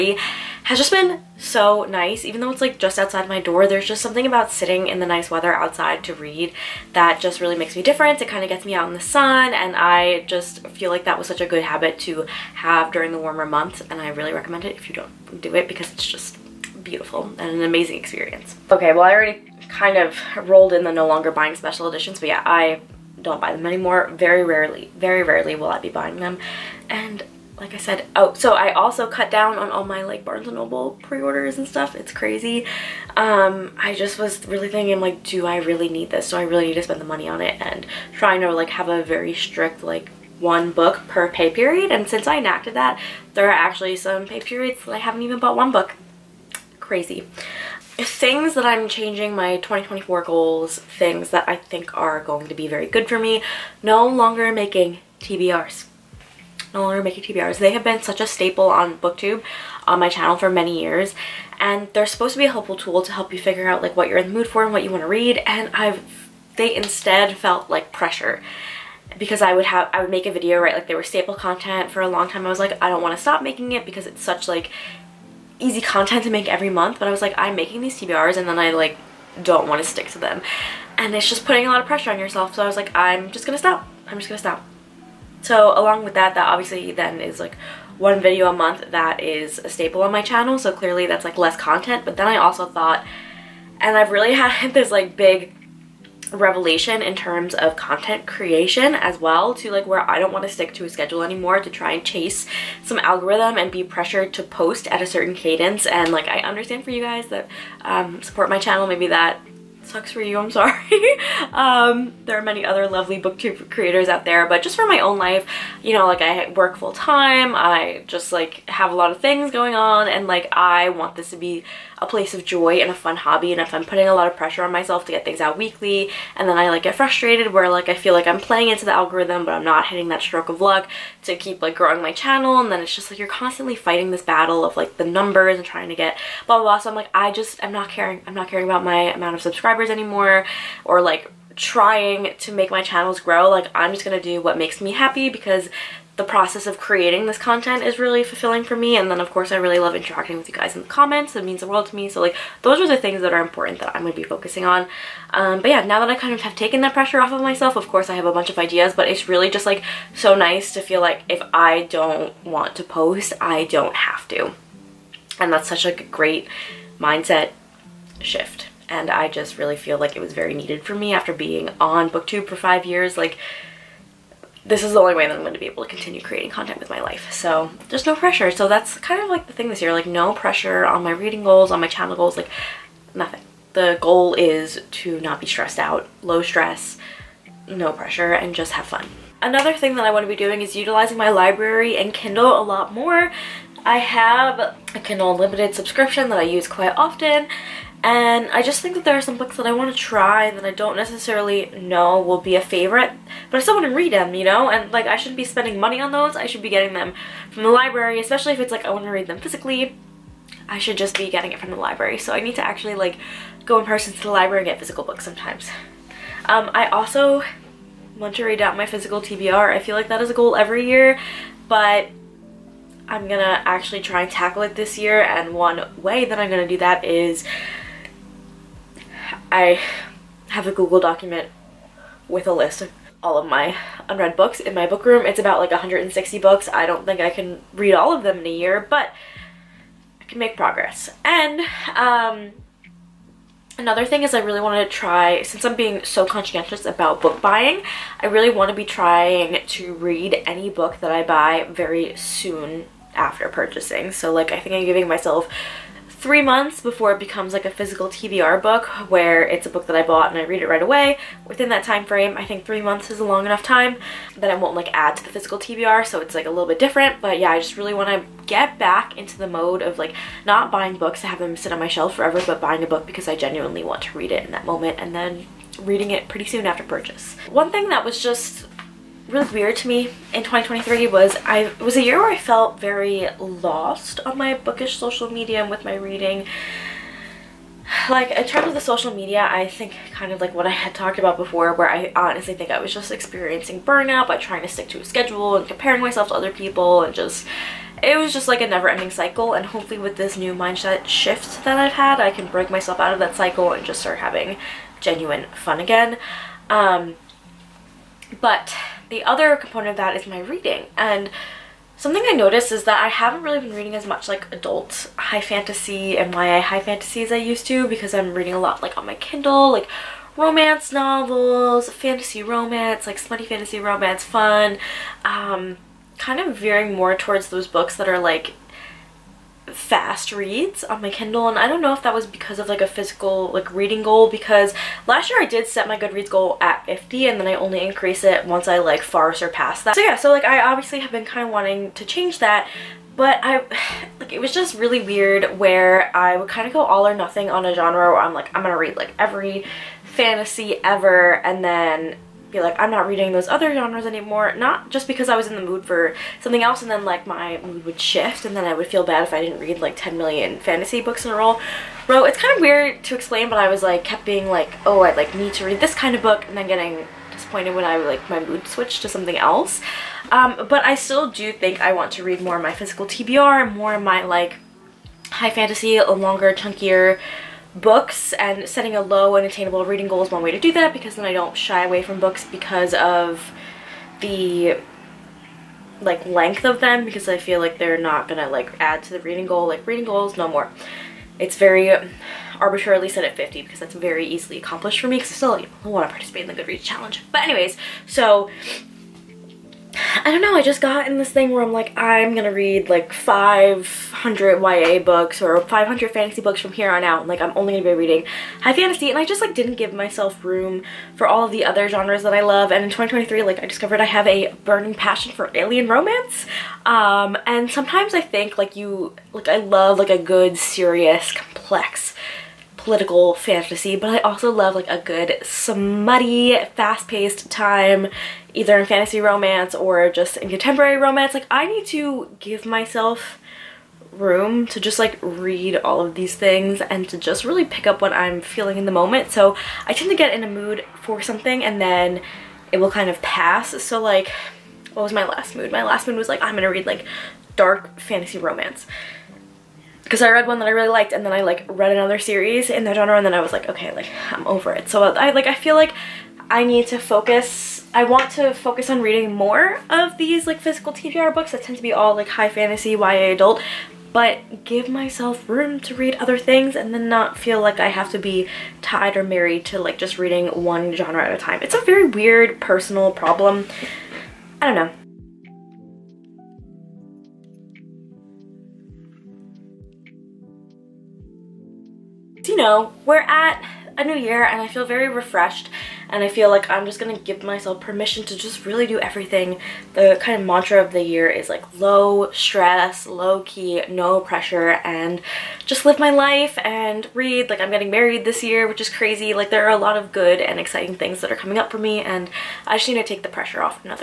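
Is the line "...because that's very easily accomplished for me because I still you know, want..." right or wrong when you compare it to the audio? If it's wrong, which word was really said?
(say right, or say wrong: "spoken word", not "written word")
right.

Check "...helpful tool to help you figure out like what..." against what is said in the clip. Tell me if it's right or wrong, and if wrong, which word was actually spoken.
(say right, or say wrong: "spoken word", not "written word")
right.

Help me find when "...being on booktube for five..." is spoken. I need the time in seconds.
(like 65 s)
171 s.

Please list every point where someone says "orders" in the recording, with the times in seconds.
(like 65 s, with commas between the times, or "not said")
31 s.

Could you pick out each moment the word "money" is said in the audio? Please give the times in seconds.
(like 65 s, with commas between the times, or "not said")
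37 s, 205 s.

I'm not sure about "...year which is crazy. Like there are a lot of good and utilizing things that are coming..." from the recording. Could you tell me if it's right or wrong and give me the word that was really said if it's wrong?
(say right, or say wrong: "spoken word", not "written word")
wrong: "exciting", not "utilizing".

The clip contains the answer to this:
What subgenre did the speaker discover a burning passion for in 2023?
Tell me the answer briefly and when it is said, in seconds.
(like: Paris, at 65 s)
alien romance, at 415 s.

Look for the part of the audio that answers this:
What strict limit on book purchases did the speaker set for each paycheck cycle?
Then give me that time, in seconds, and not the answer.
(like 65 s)
40 s.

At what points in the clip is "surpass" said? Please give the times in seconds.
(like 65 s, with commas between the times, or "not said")
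339 s.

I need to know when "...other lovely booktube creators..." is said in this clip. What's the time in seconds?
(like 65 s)
112 s.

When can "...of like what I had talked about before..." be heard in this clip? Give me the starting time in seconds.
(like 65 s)
290 s.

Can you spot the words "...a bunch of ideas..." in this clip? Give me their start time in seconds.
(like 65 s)
158 s.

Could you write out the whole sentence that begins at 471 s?
It's a very weird personal problem.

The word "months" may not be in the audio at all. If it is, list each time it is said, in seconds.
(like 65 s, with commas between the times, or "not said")
13 s, 76 s, 88 s, 256 s, 262 s.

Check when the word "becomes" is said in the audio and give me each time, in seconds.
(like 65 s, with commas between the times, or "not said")
257 s.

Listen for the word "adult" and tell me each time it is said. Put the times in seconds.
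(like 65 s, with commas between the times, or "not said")
314 s, 463 s.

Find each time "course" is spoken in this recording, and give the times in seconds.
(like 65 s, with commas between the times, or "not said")
149 s, 157 s.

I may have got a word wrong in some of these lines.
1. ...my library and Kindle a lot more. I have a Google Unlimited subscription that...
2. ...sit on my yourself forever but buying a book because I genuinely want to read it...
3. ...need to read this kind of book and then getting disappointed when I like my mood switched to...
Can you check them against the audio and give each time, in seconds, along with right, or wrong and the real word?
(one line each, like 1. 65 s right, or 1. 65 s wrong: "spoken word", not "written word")
1. 191 s wrong: "Kindle", not "Google"
2. 271 s wrong: "shelf", not "yourself"
3. 365 s right.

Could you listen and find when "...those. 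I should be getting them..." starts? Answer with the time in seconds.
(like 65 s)
206 s.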